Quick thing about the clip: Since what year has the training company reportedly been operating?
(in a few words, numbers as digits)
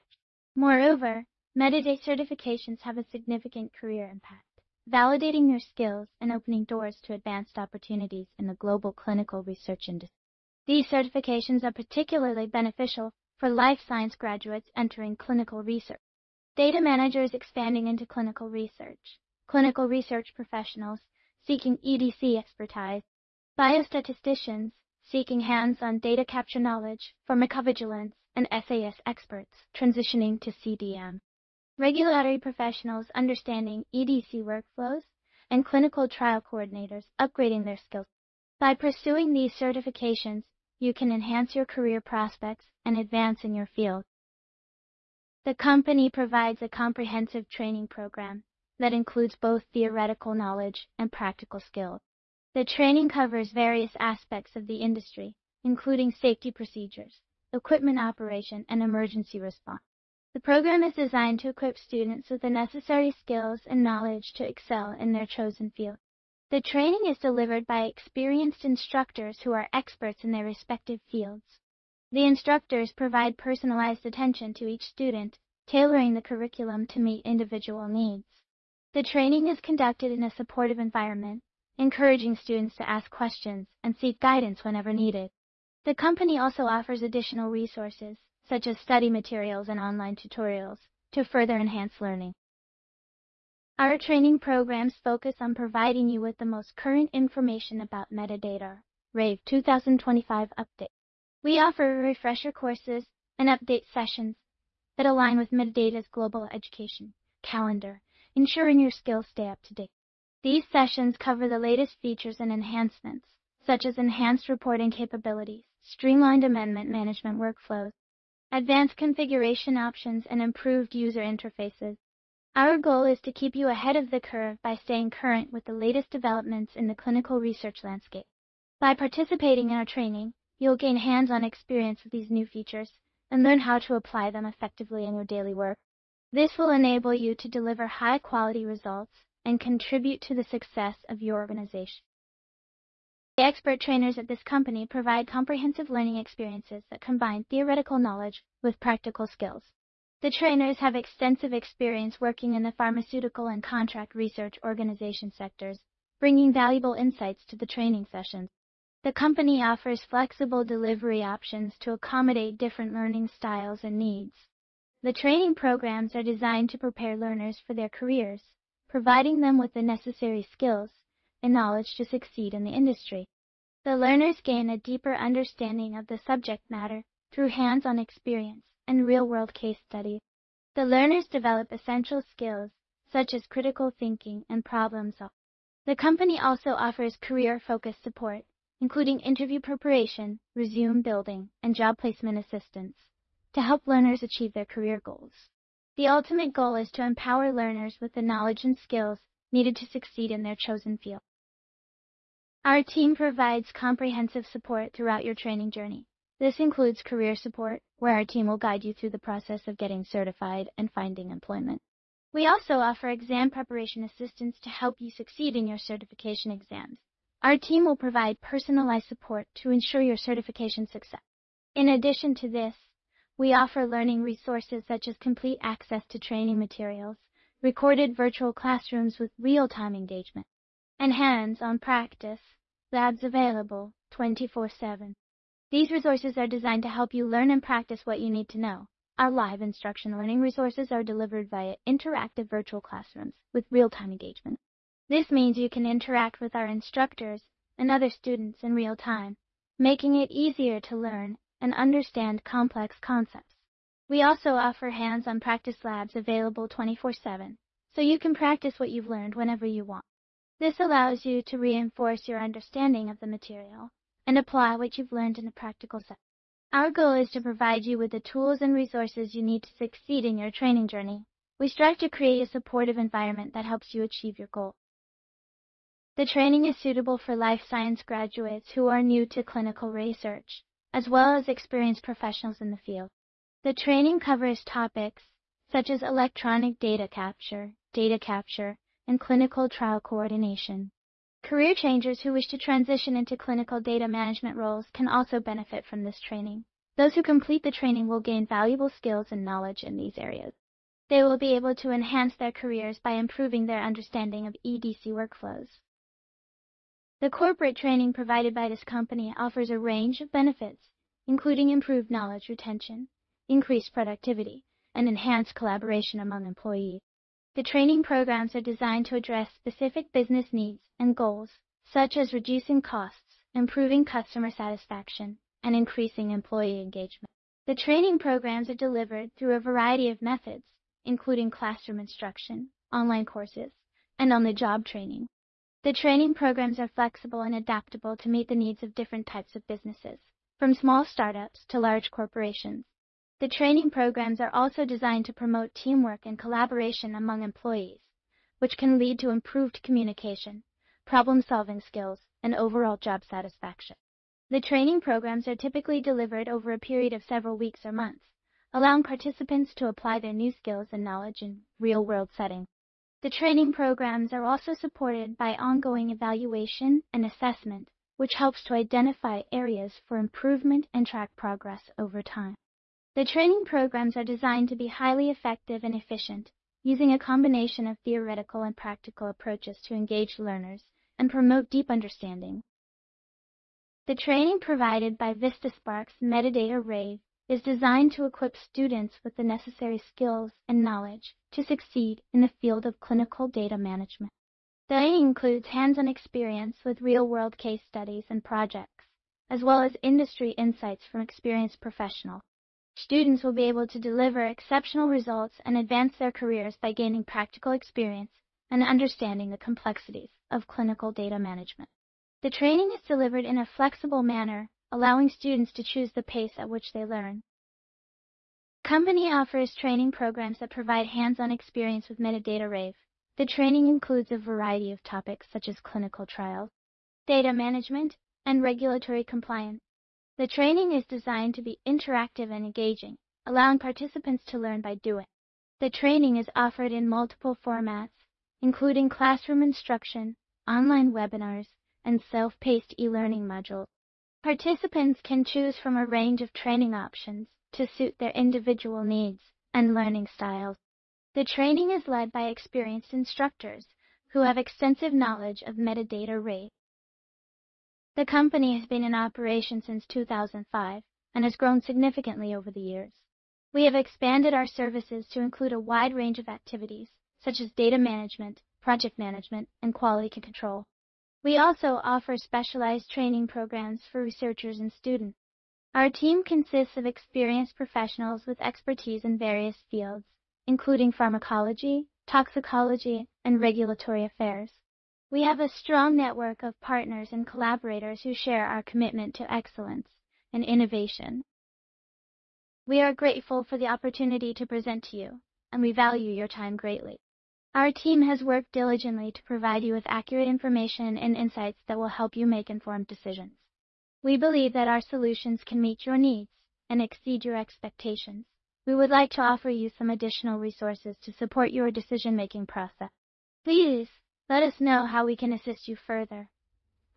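2005.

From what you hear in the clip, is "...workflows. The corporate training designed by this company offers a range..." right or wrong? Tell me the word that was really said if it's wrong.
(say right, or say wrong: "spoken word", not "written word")
wrong: "provided", not "designed".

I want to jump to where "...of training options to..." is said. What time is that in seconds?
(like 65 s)
446 s.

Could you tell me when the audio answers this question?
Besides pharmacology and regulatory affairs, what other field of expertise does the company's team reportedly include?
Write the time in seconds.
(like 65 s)
482 s.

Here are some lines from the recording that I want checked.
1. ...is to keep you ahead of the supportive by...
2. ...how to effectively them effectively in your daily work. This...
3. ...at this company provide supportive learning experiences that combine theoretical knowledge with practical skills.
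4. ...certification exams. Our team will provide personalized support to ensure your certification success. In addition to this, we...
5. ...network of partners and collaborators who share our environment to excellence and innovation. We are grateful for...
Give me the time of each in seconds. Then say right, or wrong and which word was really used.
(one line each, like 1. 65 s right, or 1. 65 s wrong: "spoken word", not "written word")
1. 123 s wrong: "curve", not "supportive"
2. 133 s wrong: "apply", not "effectively"
3. 144 s wrong: "comprehensive", not "supportive"
4. 215 s right
5. 486 s wrong: "commitment", not "environment".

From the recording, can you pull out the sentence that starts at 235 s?
These resources are designed to help you learn and practice what you need to know.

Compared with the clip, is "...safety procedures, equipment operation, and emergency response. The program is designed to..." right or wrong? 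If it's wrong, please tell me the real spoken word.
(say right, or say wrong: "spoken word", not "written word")
right.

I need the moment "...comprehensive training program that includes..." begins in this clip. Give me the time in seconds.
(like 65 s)
46 s.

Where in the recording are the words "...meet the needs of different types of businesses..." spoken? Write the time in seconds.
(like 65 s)
338 s.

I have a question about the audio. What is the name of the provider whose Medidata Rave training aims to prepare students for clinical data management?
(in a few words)
Vistasparks.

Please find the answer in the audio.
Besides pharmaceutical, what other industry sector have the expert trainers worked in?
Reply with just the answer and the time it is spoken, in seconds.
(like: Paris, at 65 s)
contract research organization, at 153 s.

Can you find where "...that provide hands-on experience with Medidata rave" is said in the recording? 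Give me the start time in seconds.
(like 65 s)
420 s.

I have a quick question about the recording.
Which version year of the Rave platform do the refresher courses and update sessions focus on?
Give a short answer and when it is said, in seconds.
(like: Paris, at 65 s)
2025, at 99 s.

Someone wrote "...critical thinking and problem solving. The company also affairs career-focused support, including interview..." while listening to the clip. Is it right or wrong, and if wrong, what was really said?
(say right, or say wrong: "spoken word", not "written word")
wrong: "offers", not "affairs".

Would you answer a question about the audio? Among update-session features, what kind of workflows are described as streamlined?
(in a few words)
amendment management.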